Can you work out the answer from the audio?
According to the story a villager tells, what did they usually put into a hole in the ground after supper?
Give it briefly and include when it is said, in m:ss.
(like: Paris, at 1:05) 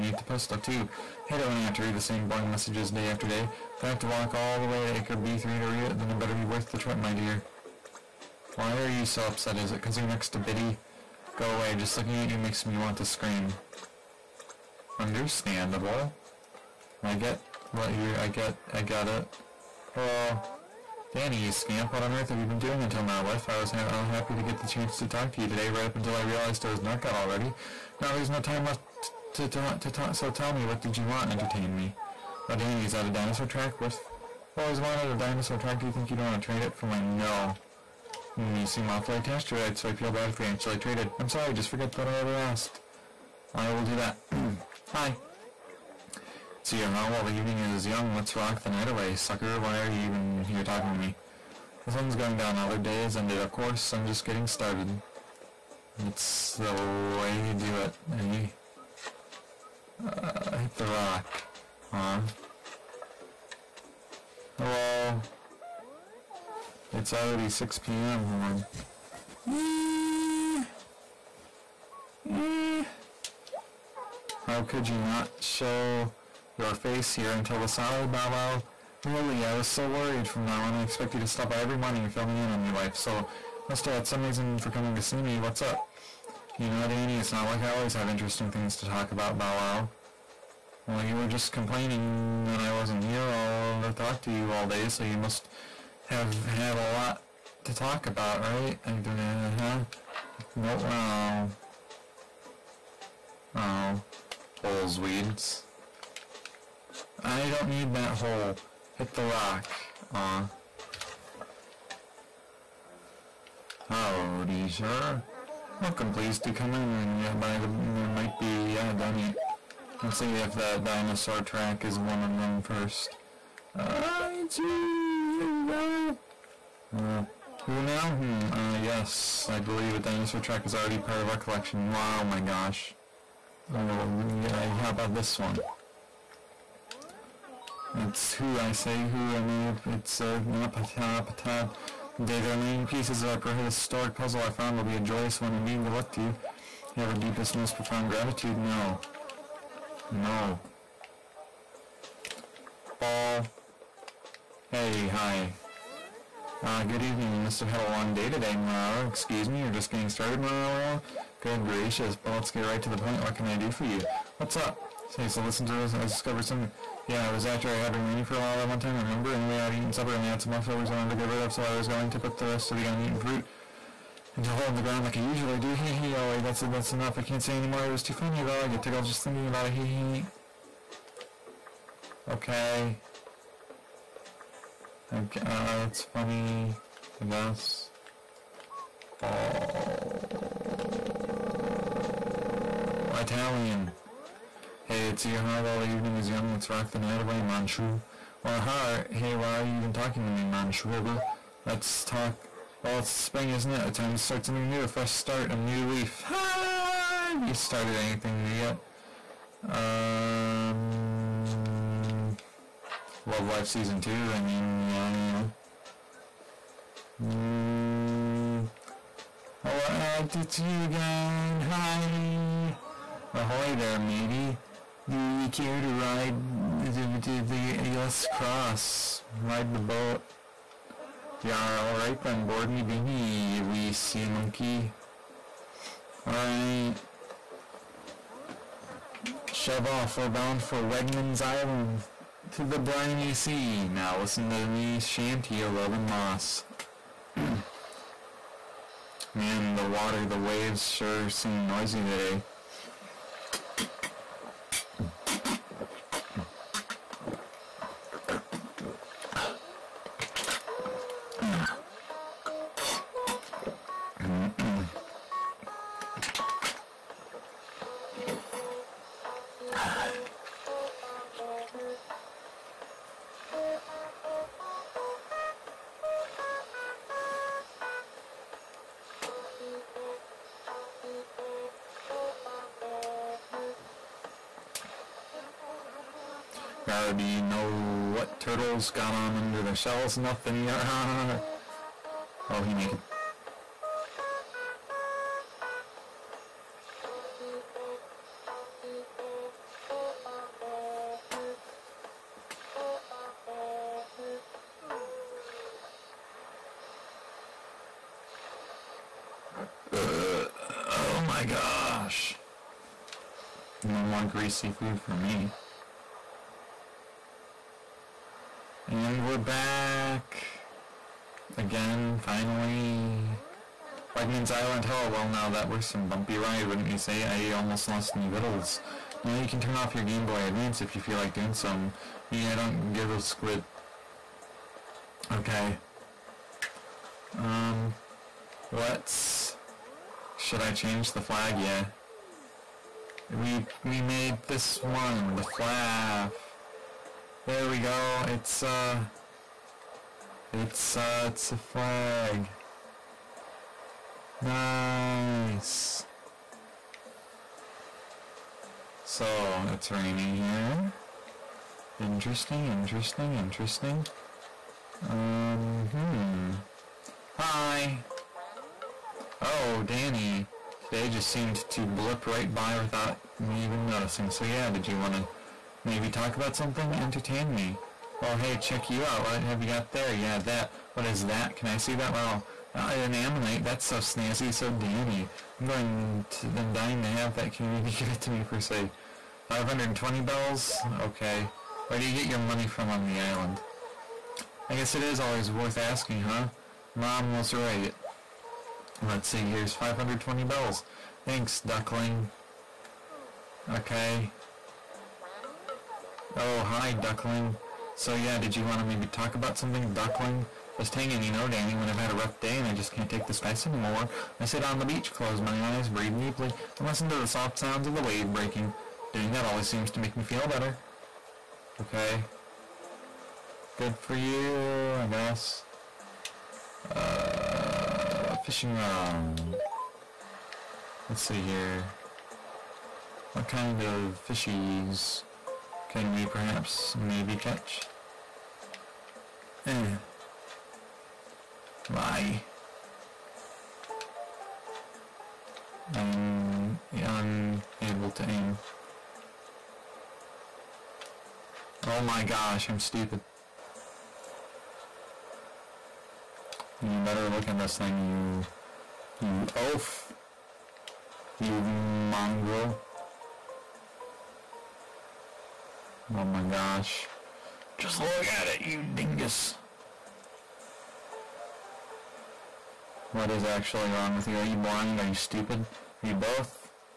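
uneaten fruit, at 2:52.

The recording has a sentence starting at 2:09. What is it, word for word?
I believe a dinosaur track is already part of our collection.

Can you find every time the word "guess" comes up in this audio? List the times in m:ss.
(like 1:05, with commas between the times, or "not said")
3:07, 6:34, 7:05.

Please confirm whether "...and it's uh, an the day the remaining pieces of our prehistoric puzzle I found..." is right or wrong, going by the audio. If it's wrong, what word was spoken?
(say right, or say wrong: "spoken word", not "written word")
right.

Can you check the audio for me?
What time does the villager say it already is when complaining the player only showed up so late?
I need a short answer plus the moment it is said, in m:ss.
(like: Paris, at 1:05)
6 p.m., at 1:07.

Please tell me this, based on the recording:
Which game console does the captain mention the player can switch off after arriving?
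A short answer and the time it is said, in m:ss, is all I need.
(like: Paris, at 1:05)
Game Boy Advance, at 5:30.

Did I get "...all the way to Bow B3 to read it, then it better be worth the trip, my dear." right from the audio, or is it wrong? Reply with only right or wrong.
wrong.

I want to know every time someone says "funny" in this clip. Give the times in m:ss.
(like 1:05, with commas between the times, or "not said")
2:58, 3:06.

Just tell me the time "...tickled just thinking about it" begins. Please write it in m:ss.
2:58.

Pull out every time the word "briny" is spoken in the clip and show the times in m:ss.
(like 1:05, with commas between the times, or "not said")
4:02.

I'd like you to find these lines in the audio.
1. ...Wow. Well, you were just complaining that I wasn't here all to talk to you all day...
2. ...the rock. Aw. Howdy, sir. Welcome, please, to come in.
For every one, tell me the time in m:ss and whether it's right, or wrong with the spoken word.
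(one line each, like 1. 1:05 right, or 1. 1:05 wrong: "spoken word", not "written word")
1. 1:29 right
2. 1:49 right.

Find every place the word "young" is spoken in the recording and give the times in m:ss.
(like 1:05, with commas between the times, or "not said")
0:47, 3:16.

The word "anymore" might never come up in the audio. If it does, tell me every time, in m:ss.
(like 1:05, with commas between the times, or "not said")
2:57, 6:53.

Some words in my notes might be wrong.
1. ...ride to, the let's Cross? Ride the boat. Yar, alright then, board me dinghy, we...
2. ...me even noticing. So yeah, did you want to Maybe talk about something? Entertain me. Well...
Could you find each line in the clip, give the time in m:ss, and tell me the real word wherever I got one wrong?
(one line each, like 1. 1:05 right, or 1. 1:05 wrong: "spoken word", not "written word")
1. 3:45 right
2. 6:13 right.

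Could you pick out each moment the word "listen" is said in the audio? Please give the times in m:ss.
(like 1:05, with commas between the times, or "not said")
2:45, 4:04, 6:56.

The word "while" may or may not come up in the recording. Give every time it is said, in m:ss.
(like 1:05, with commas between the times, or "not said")
0:47, 2:48.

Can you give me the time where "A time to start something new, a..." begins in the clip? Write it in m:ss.
3:23.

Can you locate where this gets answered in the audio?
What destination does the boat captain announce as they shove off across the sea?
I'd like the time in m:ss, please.
4:00.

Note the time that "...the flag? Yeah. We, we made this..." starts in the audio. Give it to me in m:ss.
5:41.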